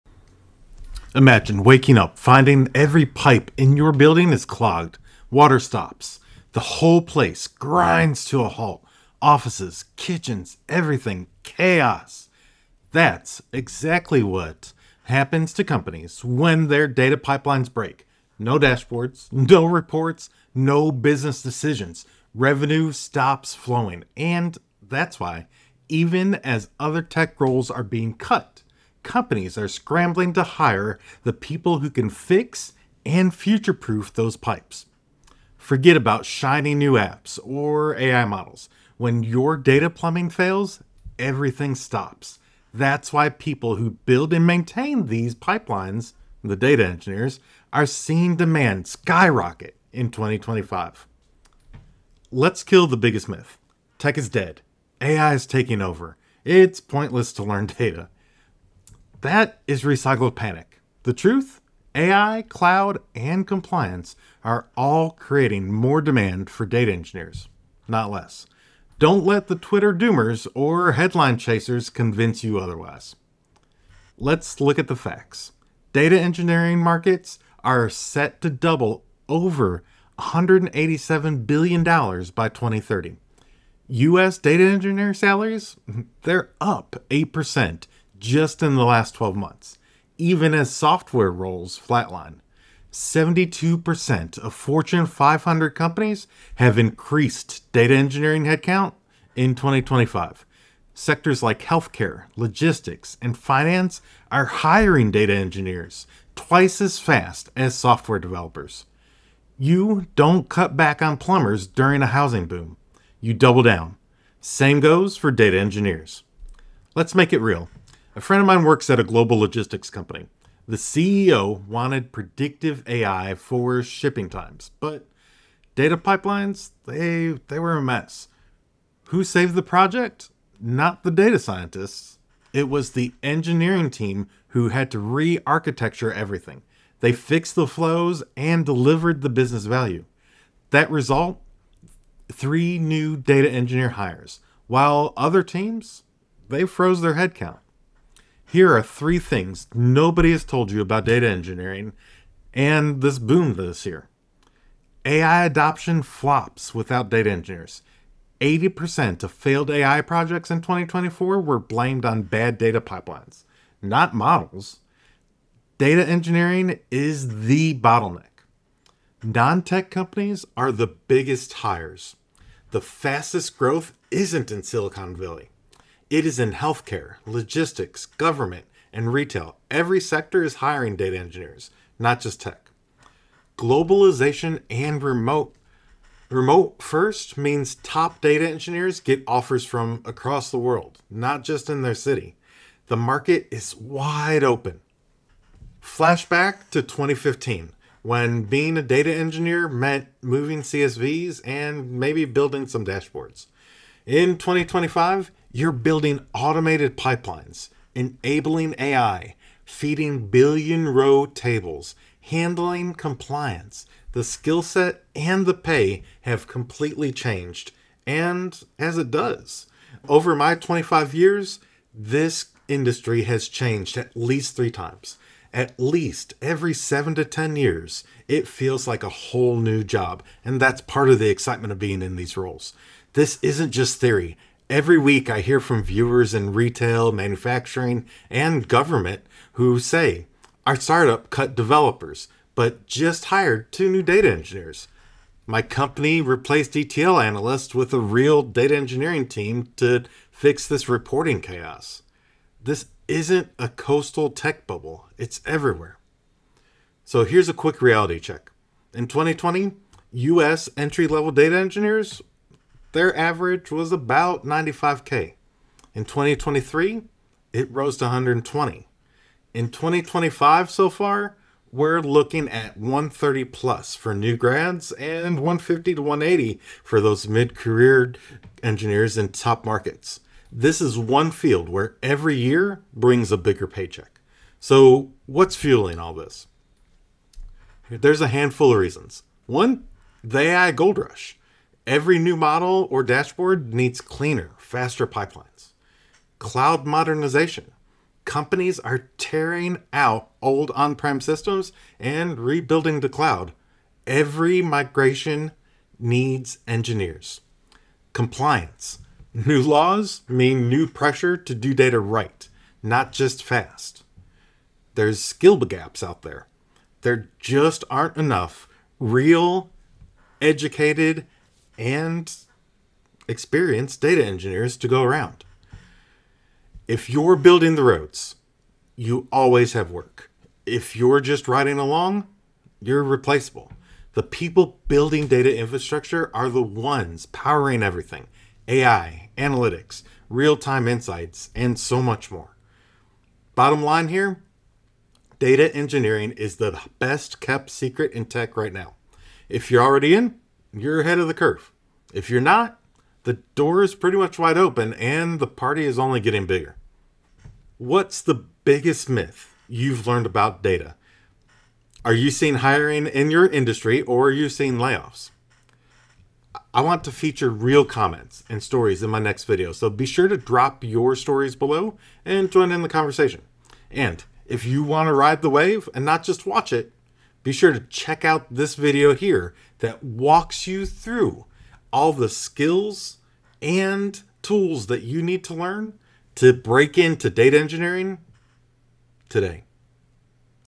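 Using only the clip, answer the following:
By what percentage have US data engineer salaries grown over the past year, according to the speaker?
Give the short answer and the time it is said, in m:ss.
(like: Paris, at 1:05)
8%, at 1:27.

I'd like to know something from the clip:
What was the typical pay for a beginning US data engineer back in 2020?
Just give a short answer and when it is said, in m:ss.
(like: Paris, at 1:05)
95K, at 4:24.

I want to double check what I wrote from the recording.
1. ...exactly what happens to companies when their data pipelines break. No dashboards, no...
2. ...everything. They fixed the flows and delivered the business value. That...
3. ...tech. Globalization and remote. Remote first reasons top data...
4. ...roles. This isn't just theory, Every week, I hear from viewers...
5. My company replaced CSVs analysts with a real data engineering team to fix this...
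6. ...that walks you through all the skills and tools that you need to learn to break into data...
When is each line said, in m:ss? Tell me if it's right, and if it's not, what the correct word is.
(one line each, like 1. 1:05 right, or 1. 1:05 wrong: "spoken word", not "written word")
1. 0:13 right
2. 2:16 right
3. 3:02 wrong: "means", not "reasons"
4. 3:52 right
5. 4:05 wrong: "ETL", not "CSVs"
6. 6:19 right.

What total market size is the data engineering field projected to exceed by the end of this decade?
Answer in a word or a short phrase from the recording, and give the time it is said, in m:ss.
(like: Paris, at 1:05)
$187 billion, at 1:20.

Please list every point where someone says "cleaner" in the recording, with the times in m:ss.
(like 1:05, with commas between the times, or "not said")
4:54.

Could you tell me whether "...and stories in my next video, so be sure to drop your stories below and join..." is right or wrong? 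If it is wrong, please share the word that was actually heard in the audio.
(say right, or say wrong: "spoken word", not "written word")
right.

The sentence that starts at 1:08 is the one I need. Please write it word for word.
Don't let the Twitter doomers or headline chasers convince you otherwise.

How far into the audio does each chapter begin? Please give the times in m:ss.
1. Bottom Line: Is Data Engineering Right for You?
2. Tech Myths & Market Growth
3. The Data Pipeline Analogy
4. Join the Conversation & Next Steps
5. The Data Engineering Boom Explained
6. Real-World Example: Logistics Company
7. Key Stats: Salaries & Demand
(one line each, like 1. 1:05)
1. 6:00
2. 1:28
3. 0:35
4. 6:25
5. 3:08
6. 2:28
7. 4:00.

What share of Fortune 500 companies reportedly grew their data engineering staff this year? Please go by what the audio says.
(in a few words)
72%.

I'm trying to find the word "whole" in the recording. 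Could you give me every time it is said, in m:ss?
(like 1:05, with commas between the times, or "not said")
0:06, 3:49.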